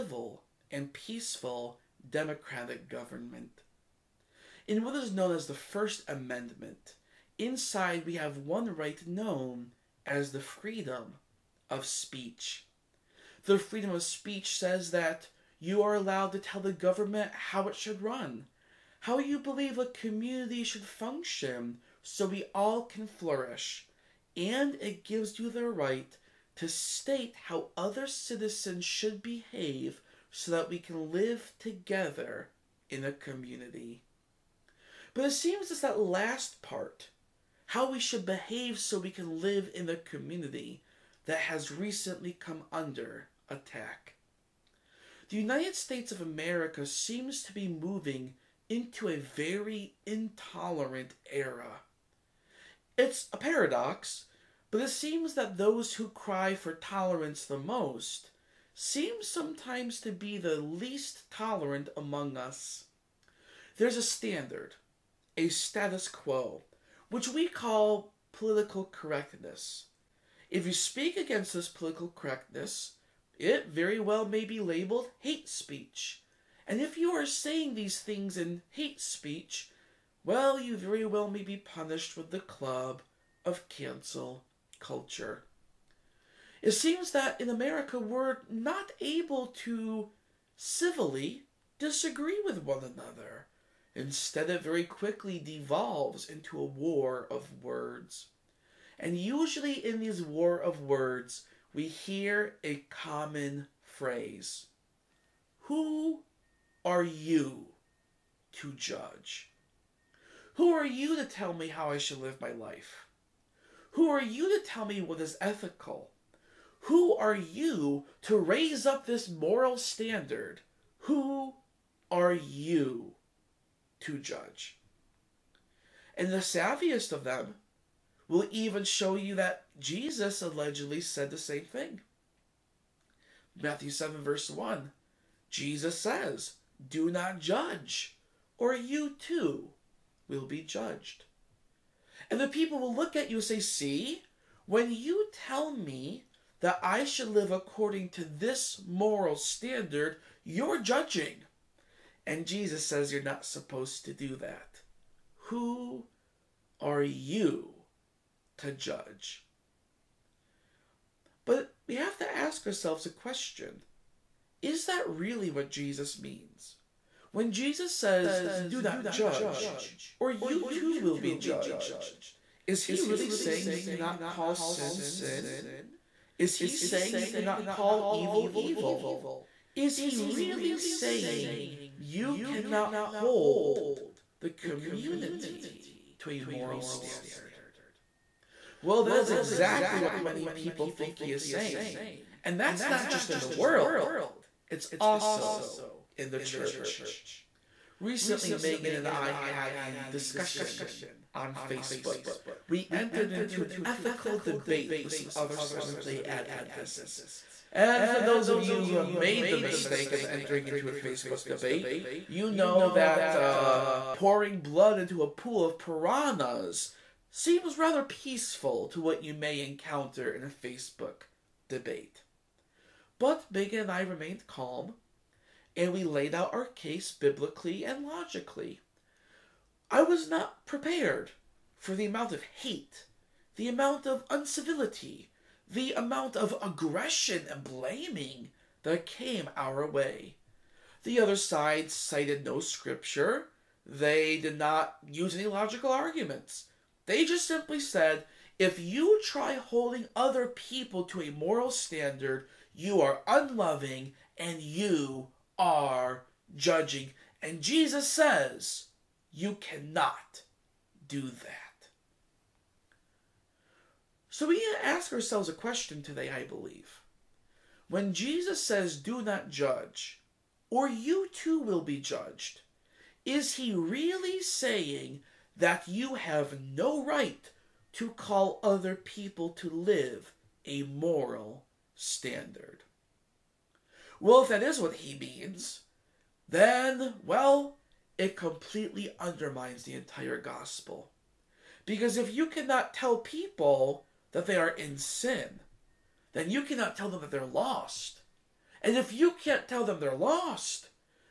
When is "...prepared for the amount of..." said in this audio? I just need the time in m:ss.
3:50.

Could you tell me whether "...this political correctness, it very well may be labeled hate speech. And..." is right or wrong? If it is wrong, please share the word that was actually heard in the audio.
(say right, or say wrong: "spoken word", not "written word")
right.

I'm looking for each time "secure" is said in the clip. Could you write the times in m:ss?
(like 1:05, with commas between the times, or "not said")
not said.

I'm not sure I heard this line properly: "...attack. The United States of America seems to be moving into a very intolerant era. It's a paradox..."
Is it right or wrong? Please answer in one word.
right.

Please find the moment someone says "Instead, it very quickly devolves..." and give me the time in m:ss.
1:33.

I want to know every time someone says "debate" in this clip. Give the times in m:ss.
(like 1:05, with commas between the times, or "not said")
3:24, 3:31, 3:41.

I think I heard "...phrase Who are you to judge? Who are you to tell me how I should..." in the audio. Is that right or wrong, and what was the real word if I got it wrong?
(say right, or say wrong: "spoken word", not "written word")
right.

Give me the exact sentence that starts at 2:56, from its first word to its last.
Is he saying you cannot call evil evil?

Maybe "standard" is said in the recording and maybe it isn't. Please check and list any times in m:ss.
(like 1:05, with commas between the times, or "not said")
1:04, 1:59, 2:29, 3:06, 4:11, 4:41.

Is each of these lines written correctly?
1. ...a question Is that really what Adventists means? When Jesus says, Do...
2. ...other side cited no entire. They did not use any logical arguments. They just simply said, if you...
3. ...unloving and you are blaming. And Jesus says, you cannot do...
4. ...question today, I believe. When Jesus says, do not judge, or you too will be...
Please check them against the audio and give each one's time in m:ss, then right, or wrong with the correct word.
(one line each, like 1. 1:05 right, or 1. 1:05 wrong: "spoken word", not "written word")
1. 2:43 wrong: "Jesus", not "Adventists"
2. 4:01 wrong: "scripture", not "entire"
3. 4:13 wrong: "judging", not "blaming"
4. 4:25 right.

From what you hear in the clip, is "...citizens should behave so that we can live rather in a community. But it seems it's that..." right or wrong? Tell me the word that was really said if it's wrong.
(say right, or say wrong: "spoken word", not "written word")
wrong: "together", not "rather".